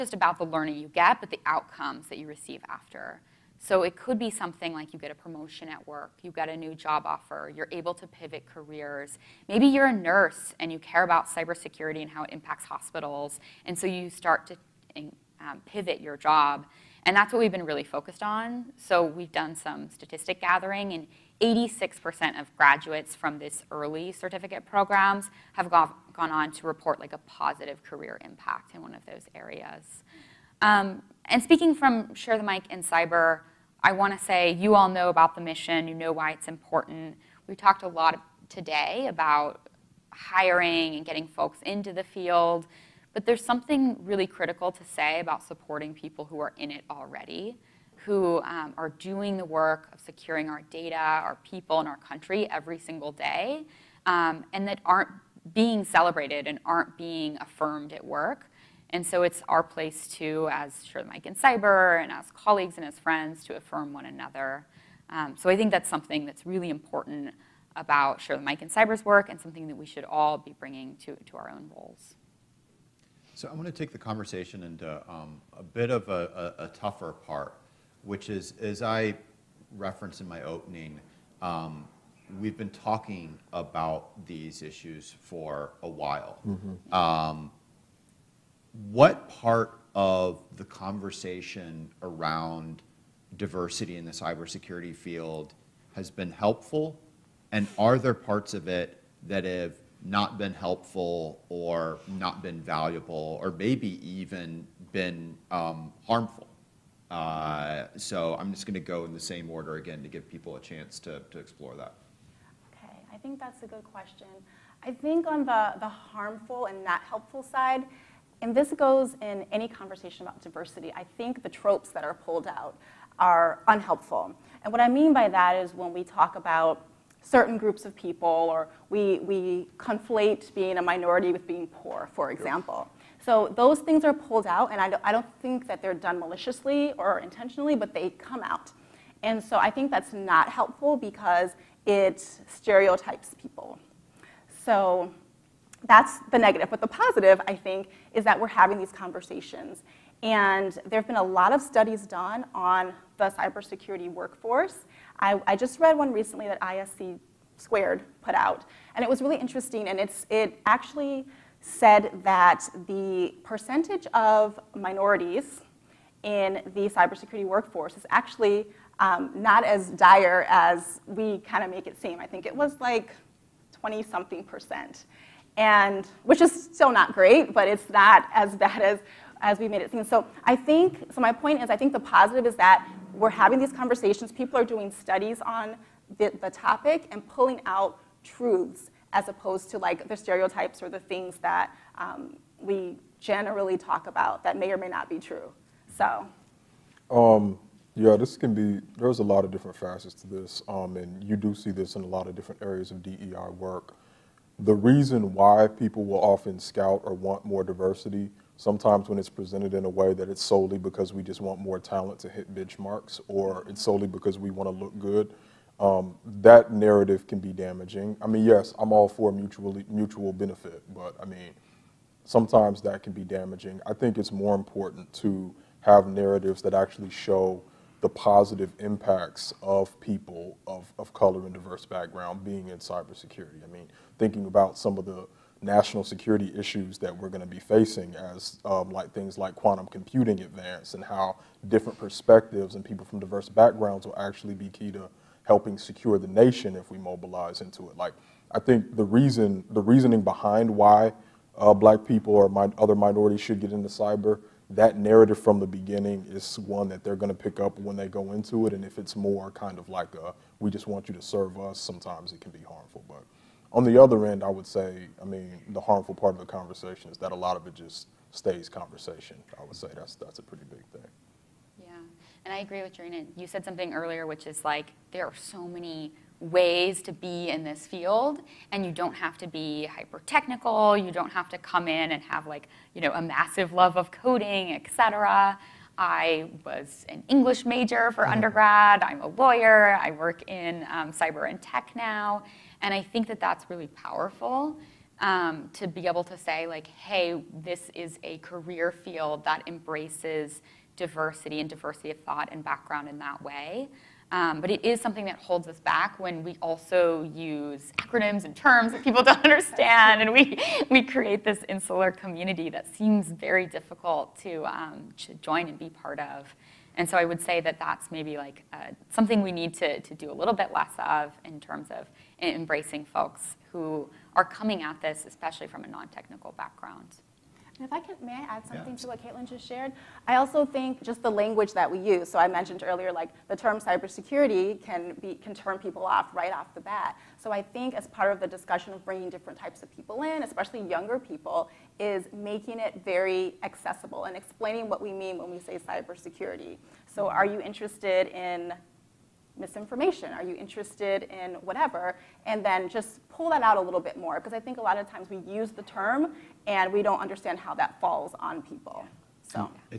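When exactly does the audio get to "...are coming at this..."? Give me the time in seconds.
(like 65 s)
324 s.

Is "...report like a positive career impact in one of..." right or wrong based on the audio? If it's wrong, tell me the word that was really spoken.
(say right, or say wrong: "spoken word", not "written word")
right.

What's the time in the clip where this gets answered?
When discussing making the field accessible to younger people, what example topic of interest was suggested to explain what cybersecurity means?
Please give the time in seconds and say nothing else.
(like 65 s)
349 s.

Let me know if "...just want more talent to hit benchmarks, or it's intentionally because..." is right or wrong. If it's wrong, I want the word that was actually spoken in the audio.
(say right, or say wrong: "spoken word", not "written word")
wrong: "solely", not "intentionally".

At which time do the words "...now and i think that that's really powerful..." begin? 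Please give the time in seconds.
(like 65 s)
291 s.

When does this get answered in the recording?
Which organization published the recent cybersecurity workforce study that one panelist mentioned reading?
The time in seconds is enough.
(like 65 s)
156 s.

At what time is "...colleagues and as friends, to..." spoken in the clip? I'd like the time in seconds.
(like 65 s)
62 s.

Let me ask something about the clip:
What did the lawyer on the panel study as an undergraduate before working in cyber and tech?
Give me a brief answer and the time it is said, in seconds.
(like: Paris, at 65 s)
English, at 287 s.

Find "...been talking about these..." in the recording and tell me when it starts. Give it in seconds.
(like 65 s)
82 s.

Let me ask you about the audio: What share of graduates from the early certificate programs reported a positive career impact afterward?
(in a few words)
86%.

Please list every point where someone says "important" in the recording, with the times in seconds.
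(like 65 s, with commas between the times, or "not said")
36 s, 66 s, 224 s.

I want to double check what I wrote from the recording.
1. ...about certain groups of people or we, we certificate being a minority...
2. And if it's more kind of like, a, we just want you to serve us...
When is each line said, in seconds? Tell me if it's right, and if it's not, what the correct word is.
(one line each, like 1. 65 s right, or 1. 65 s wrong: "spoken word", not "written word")
1. 126 s wrong: "conflate", not "certificate"
2. 258 s right.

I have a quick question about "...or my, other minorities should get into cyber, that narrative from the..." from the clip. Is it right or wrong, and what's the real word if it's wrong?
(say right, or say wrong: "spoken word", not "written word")
right.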